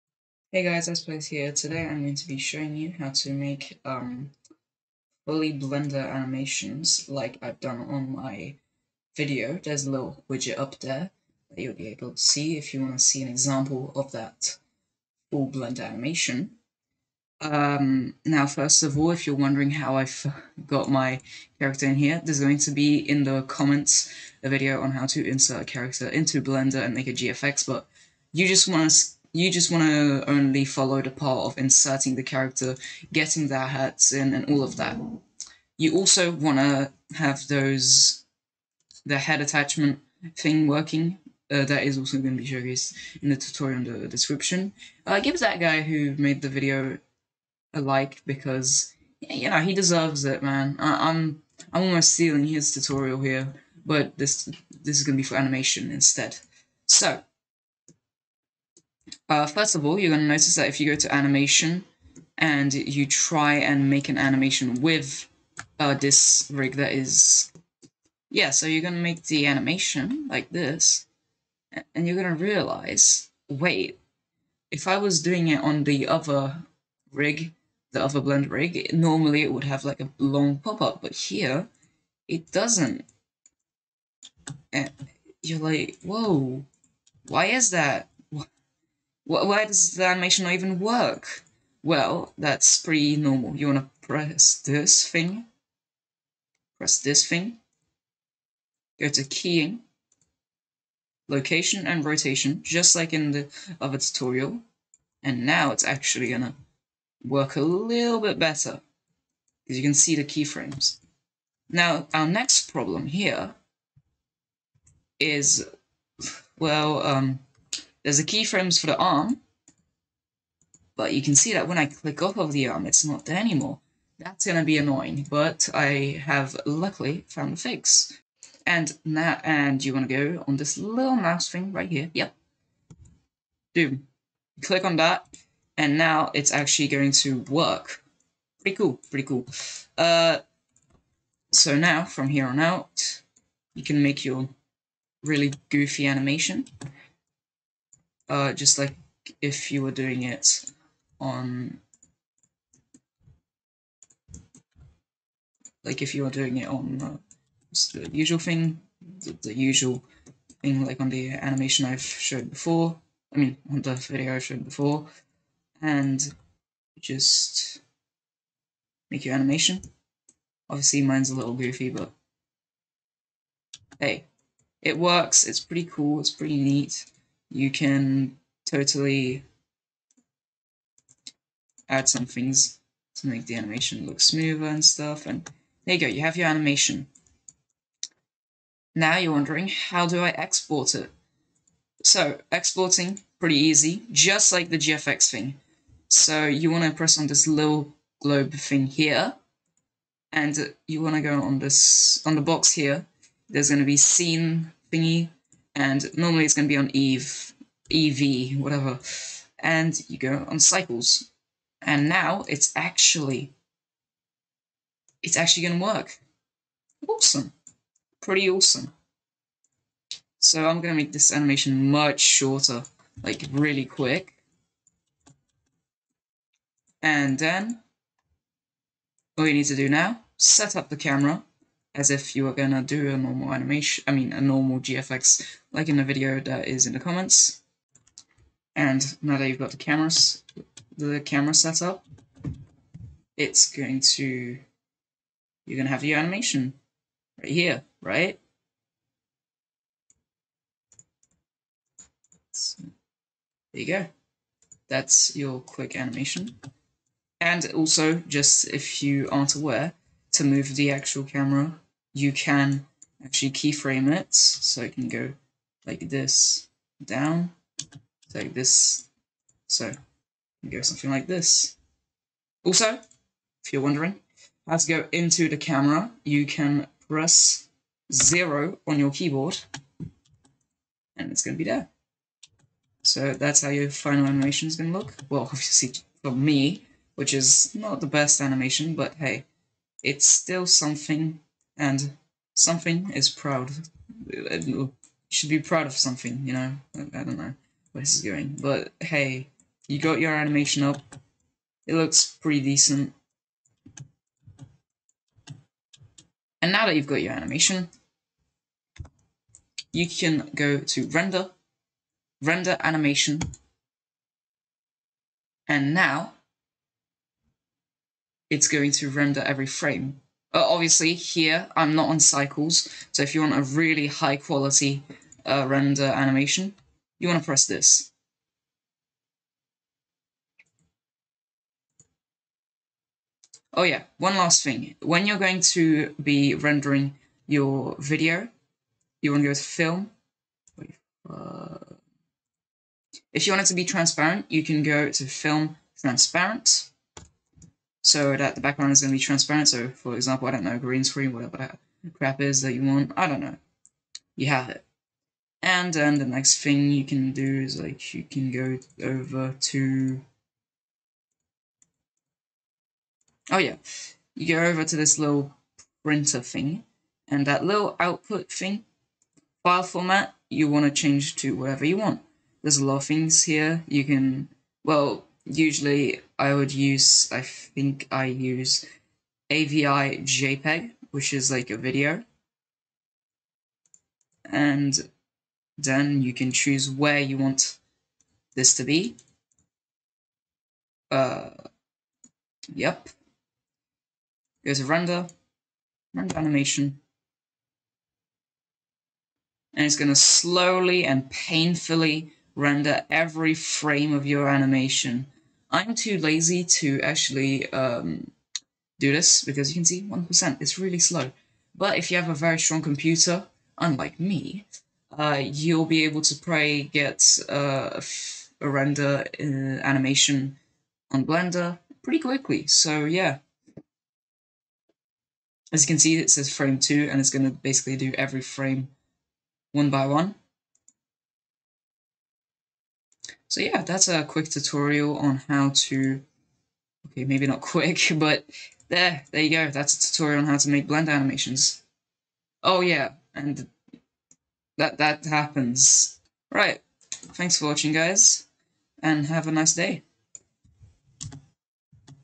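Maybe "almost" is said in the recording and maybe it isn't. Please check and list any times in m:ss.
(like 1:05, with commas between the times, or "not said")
0:51.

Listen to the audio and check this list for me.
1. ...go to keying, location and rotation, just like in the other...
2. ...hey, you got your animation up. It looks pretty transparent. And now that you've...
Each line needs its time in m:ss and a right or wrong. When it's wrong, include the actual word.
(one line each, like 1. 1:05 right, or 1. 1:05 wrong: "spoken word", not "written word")
1. 1:38 right
2. 4:58 wrong: "decent", not "transparent".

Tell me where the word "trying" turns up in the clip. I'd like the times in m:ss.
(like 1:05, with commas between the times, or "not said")
not said.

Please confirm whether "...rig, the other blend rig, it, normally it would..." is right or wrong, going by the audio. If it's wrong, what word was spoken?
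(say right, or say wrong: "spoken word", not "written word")
right.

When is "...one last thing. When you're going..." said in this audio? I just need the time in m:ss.
5:34.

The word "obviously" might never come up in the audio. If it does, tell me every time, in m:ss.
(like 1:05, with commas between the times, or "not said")
2:50, 4:45, 5:20.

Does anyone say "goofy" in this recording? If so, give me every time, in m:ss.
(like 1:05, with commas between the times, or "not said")
2:25, 2:51.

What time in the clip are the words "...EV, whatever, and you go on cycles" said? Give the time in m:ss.
3:27.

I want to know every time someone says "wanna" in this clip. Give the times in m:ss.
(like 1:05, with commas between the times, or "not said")
1:33, 2:09.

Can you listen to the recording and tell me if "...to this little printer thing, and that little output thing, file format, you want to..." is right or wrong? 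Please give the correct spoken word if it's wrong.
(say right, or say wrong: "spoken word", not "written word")
right.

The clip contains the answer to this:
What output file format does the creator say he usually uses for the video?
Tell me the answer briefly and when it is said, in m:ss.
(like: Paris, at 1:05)
AVI JPEG, at 6:19.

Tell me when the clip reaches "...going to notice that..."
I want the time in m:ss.
1:00.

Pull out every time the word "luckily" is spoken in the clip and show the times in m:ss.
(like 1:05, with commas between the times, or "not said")
2:06.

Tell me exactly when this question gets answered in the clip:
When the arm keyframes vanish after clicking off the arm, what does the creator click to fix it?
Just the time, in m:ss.
2:11.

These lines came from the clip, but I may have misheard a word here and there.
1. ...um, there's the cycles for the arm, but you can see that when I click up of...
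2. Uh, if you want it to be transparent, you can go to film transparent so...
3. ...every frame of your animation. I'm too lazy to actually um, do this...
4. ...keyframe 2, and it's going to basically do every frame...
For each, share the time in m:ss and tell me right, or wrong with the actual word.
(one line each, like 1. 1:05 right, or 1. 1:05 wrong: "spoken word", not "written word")
1. 1:57 wrong: "keyframes", not "cycles"
2. 5:41 right
3. 6:43 right
4. 7:06 wrong: "frame", not "keyframe".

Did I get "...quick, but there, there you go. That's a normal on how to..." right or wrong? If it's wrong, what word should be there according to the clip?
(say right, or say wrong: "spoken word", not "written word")
wrong: "tutorial", not "normal".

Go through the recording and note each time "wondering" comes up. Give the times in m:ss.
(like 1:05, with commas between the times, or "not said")
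0:19, 3:09, 4:33.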